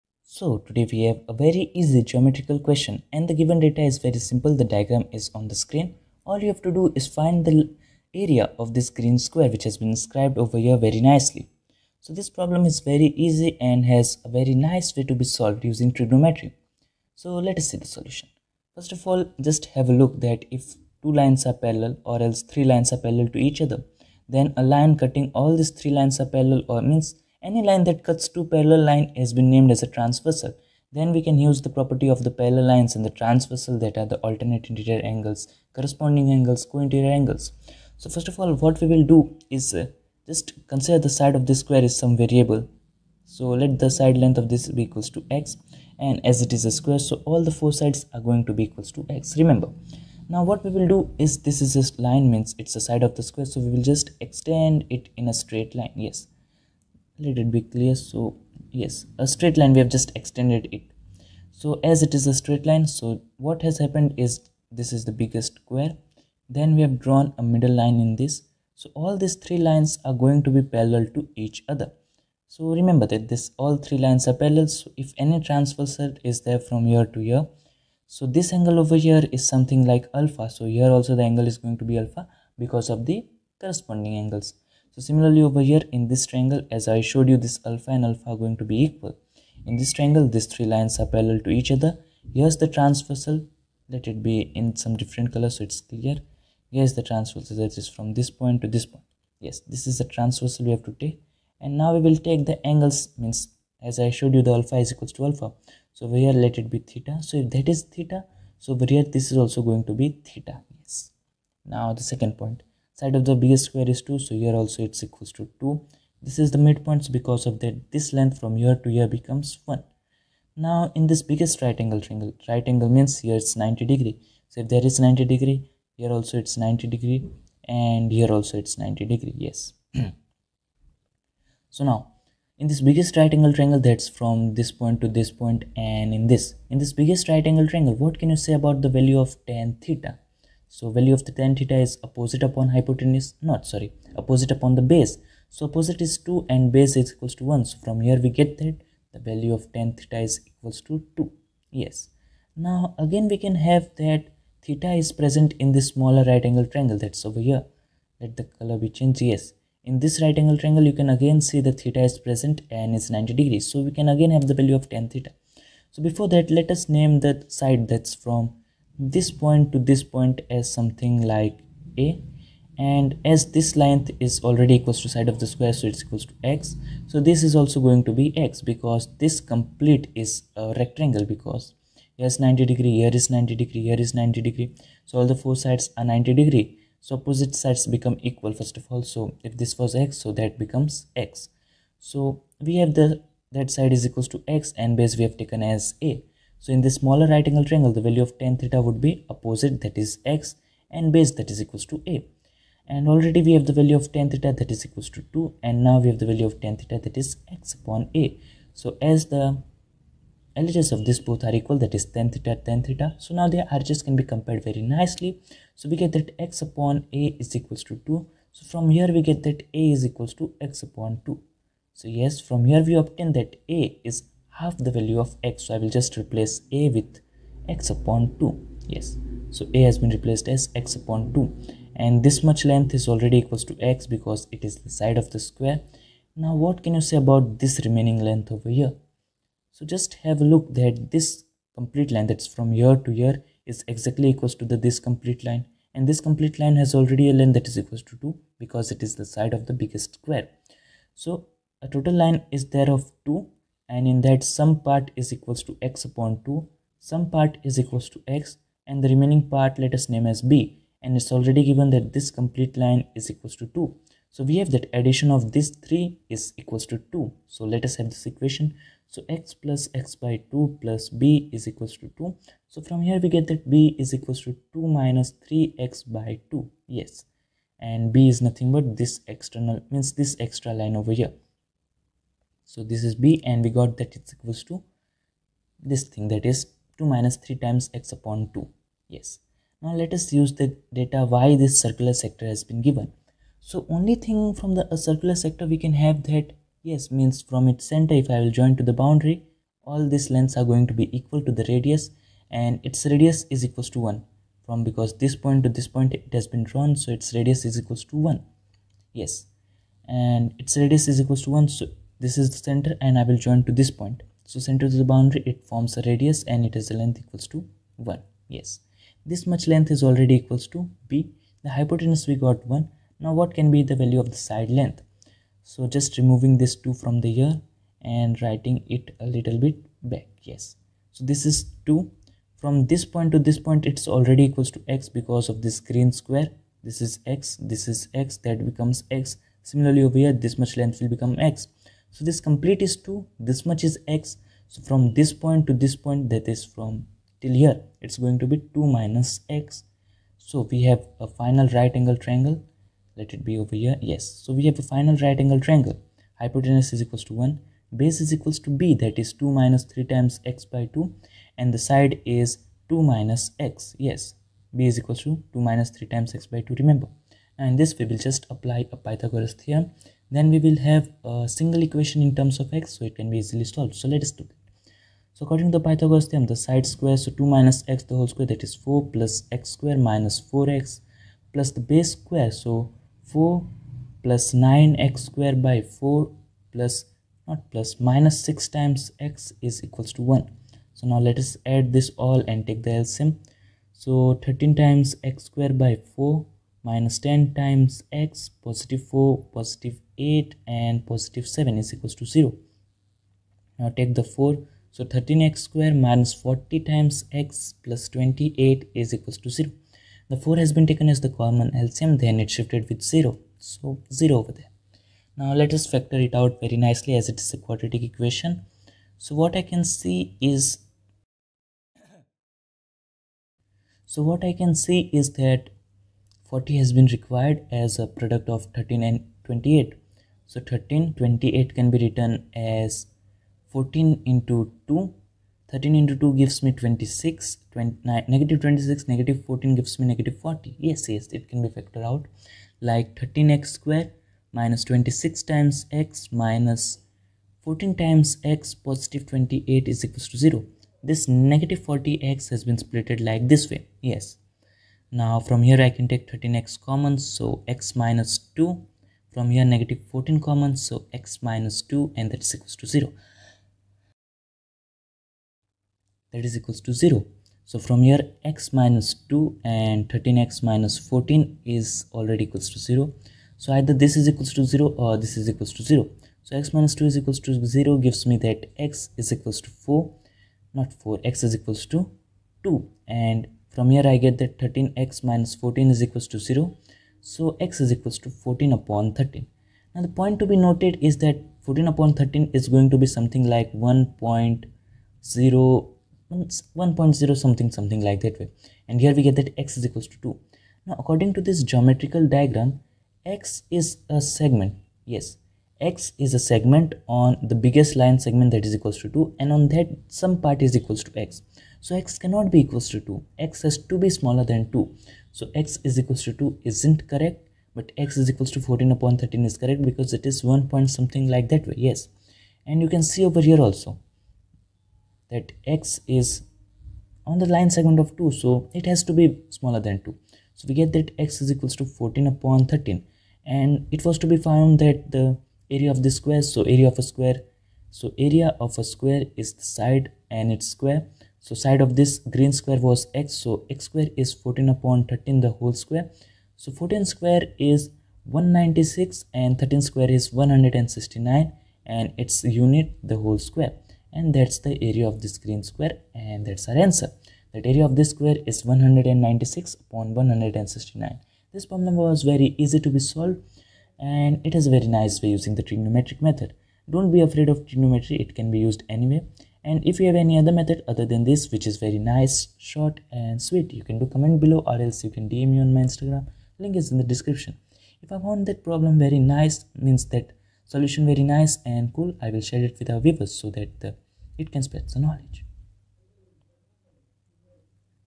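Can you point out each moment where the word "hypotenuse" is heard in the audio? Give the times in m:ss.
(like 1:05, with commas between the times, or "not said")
2:22, 5:21, 5:56.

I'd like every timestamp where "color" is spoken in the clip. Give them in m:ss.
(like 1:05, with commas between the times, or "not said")
1:35, 2:38.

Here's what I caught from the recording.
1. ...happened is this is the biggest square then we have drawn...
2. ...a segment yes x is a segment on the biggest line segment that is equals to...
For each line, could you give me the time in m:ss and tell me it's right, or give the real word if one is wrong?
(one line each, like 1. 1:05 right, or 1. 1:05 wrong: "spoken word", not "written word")
1. 1:03 right
2. 8:24 right.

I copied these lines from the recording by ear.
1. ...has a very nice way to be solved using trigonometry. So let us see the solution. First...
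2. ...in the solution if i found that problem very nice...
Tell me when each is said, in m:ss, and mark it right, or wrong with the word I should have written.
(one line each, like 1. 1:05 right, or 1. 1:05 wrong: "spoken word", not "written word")
1. 0:13 right
2. 9:36 wrong: "description", not "solution".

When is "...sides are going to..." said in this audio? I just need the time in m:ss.
0:47.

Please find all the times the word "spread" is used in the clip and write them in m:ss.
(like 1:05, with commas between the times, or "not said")
9:44.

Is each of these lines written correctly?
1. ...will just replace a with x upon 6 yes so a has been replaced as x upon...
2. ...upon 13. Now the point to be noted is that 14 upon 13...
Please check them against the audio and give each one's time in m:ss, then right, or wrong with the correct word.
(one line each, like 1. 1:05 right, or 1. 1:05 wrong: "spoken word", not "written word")
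1. 3:45 wrong: "2", not "6"
2. 8:08 right.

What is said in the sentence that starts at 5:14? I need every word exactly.
So center to the boundary, it forms a radius and it is the a length equals to 1.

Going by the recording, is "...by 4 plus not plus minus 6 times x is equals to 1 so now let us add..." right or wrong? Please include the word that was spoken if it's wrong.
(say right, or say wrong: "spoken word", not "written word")
right.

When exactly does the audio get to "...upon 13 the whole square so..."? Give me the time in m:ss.
9:04.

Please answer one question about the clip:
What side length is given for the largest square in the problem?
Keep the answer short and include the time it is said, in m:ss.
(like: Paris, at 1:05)
2, at 1:53.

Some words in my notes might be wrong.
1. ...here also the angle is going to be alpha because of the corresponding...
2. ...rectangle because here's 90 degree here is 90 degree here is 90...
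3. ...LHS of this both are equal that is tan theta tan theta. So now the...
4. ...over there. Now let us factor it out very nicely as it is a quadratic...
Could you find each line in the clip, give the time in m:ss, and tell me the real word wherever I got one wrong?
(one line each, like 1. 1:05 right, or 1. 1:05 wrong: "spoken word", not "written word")
1. 1:20 right
2. 3:00 right
3. 3:30 right
4. 6:54 right.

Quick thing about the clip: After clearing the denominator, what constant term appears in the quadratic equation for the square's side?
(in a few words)
28.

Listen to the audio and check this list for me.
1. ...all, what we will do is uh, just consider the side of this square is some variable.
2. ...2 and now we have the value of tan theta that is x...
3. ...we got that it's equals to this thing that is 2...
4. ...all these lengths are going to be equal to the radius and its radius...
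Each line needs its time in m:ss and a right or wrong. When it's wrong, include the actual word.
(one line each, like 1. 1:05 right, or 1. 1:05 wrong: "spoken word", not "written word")
1. 0:38 right
2. 3:25 right
3. 4:43 right
4. 4:59 right.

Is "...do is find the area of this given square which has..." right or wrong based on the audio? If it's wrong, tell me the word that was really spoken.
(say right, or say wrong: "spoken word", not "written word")
wrong: "green", not "given".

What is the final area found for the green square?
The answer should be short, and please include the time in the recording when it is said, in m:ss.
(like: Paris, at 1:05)
196/169, at 9:18.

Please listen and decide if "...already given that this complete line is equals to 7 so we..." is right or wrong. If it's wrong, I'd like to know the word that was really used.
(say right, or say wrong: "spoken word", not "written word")
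wrong: "2", not "7".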